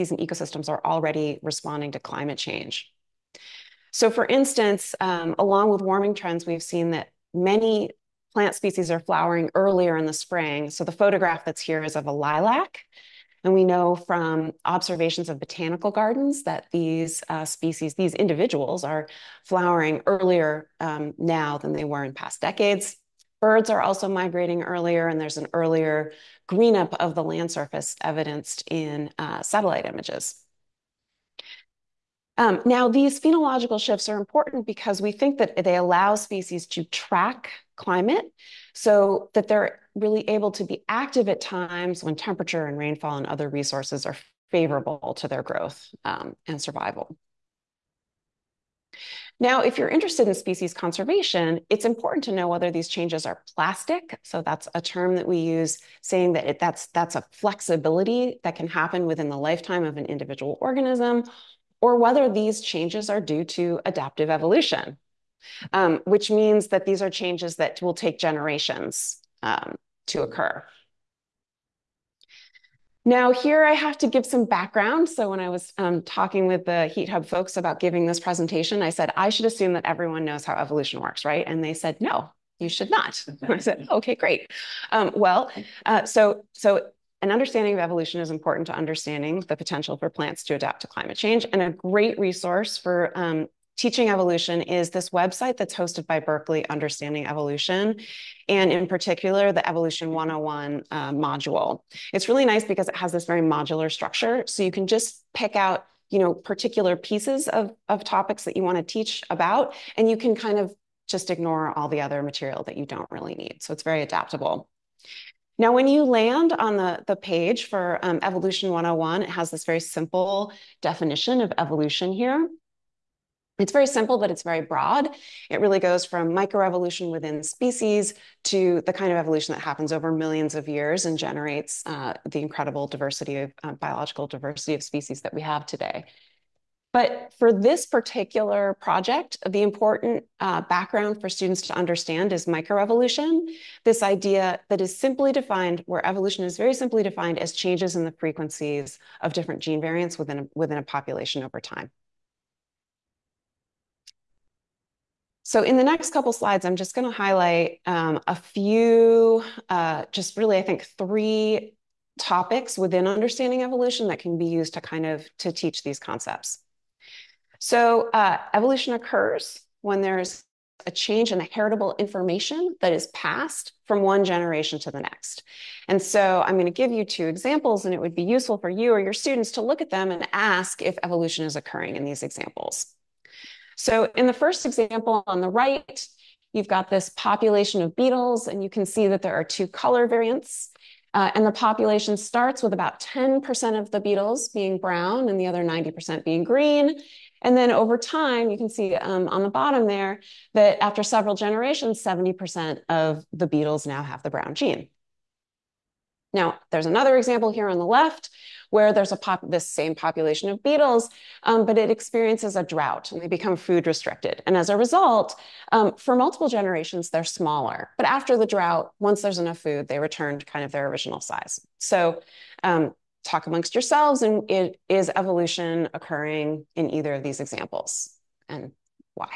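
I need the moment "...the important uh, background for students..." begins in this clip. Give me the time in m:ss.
2:19.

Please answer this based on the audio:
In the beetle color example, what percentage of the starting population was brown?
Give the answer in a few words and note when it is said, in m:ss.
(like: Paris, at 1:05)
10%, at 3:12.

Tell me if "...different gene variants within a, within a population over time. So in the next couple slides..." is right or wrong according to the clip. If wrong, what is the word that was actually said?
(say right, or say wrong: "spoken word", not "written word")
right.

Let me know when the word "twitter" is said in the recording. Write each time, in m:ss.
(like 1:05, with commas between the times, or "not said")
not said.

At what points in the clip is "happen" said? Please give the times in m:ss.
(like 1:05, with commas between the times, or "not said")
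0:58, 2:09.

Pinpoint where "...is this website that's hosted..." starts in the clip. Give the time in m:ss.
1:34.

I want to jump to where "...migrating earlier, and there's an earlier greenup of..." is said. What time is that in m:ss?
0:24.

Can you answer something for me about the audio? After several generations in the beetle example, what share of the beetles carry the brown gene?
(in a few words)
70%.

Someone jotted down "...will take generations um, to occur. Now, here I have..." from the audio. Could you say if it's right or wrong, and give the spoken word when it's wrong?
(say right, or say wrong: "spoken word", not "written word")
right.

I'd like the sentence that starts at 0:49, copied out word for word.
Now, if you're interested in species conservation, it's important to know whether these changes are plastic.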